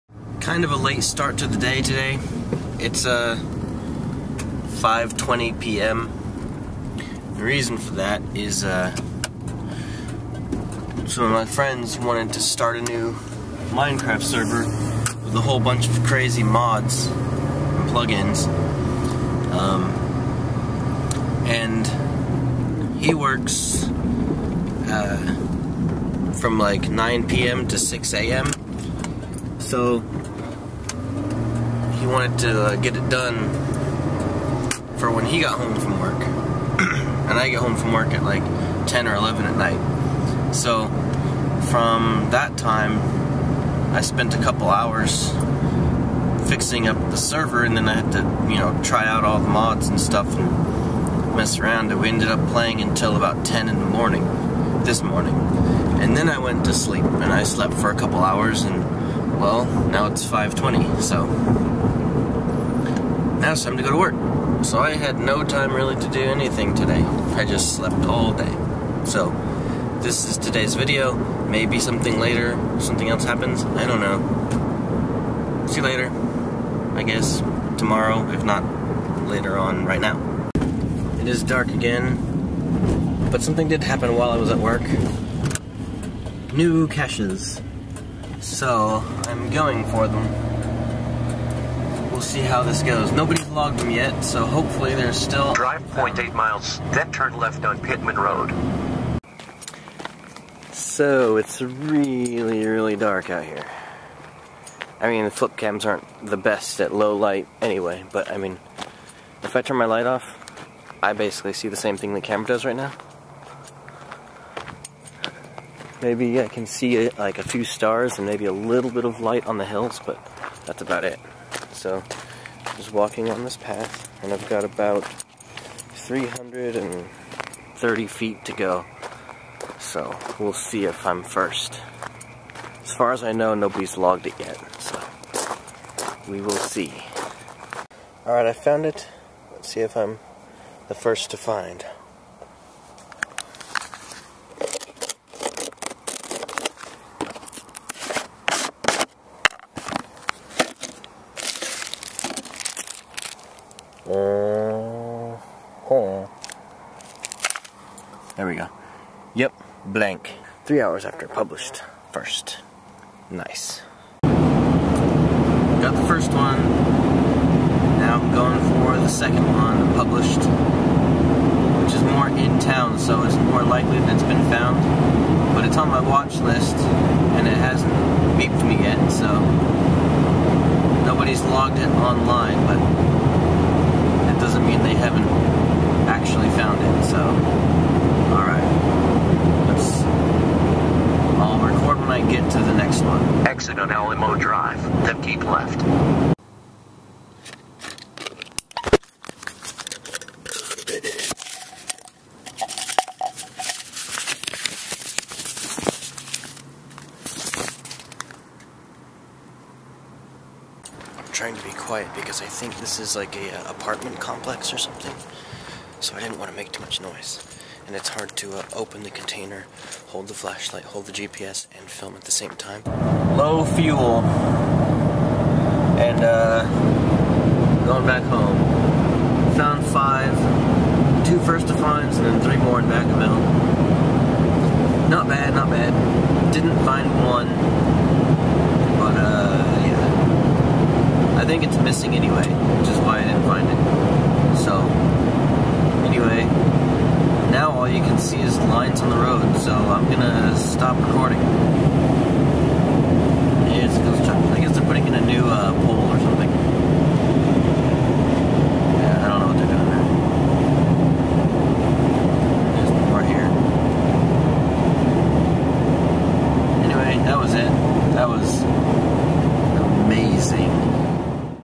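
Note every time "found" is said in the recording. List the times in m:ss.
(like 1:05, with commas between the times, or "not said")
2:18, 2:54, 3:06, 3:49.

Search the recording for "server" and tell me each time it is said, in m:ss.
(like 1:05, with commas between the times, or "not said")
0:14, 0:47.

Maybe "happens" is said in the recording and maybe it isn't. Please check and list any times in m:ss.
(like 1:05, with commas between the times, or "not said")
1:13, 1:23.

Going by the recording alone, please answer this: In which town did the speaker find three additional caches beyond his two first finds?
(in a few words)
Vacaville.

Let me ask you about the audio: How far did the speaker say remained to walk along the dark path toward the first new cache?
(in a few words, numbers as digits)
330 feet.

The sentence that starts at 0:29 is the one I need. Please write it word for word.
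So he wanted to uh, get it done for when he got home from work.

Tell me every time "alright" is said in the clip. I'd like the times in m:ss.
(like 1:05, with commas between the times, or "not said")
2:18, 3:08.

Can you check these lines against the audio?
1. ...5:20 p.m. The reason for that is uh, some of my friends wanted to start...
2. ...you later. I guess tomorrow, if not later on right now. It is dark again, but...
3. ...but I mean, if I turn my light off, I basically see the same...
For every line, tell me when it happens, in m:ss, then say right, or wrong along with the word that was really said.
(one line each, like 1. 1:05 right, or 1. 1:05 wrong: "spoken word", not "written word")
1. 0:04 right
2. 1:15 right
3. 1:48 right.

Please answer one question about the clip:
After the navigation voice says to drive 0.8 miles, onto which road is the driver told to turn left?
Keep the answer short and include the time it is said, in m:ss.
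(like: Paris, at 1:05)
Pittman Road, at 1:37.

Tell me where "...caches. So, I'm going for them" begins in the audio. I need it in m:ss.
1:26.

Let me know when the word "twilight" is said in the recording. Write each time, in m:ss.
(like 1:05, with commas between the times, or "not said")
not said.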